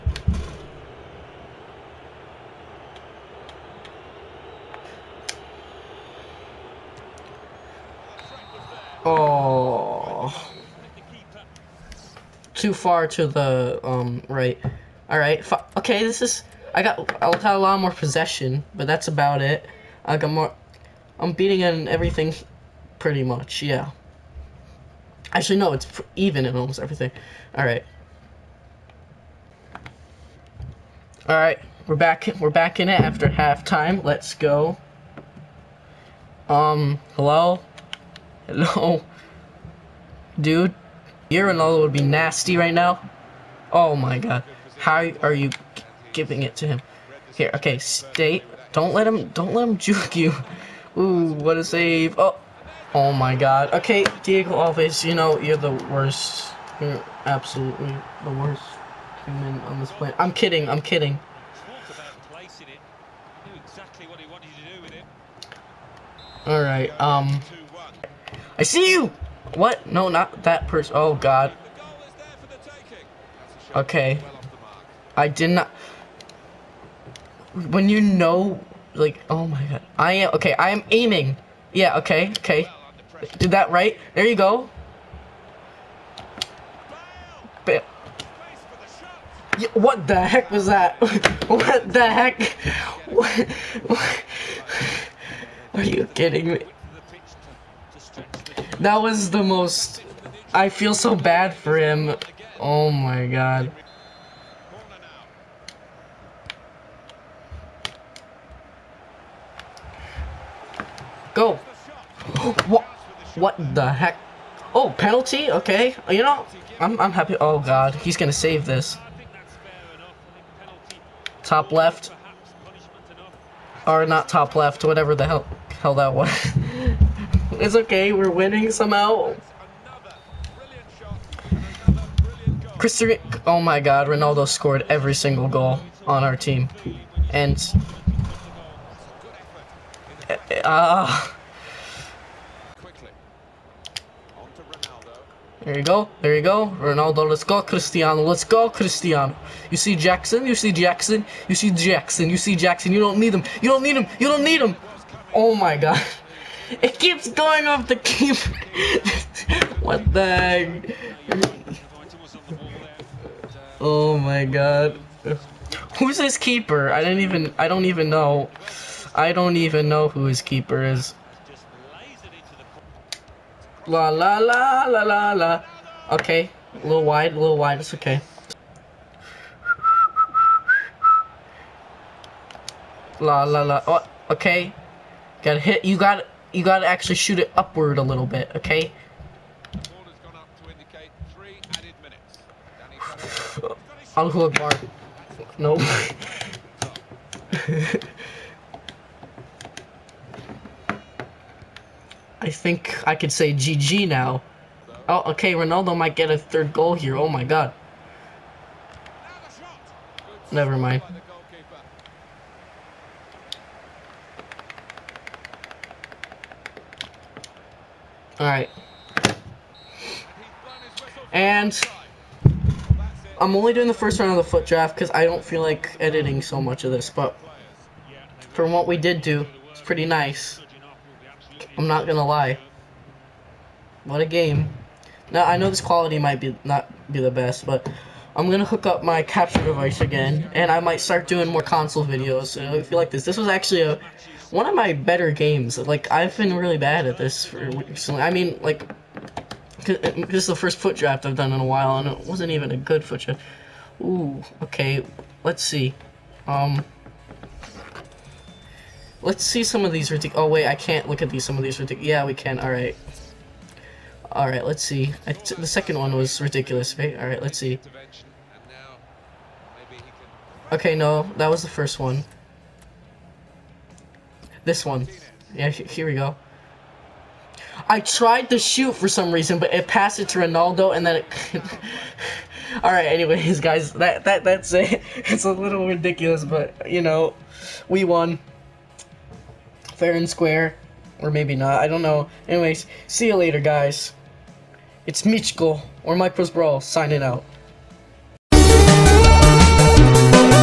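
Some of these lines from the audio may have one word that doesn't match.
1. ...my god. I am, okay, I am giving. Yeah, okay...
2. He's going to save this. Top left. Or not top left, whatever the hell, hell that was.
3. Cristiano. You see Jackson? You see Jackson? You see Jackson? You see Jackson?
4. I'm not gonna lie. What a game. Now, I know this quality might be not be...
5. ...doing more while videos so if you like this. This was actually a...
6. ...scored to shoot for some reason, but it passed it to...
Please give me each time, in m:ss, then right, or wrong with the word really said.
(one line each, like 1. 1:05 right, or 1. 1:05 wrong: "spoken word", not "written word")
1. 1:19 wrong: "aiming", not "giving"
2. 1:57 right
3. 2:28 right
4. 3:51 right
5. 4:01 wrong: "console", not "while"
6. 4:38 wrong: "tried", not "scored".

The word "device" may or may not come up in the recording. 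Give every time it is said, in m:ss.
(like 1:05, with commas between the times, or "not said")
3:59.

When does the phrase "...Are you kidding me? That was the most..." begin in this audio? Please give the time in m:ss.
1:35.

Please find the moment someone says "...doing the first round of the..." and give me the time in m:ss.
3:43.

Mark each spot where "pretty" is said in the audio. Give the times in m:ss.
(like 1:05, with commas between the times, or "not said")
0:22, 3:49.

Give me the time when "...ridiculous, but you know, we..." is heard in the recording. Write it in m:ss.
4:45.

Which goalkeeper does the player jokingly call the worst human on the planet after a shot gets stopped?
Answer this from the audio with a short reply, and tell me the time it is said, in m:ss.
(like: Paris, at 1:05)
Diego Alves, at 0:54.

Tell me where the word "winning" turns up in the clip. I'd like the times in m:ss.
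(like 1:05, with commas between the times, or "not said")
2:08.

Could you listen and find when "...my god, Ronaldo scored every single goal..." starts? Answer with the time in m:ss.
2:13.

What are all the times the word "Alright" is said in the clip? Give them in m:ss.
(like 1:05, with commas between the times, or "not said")
0:15, 1:06, 3:38.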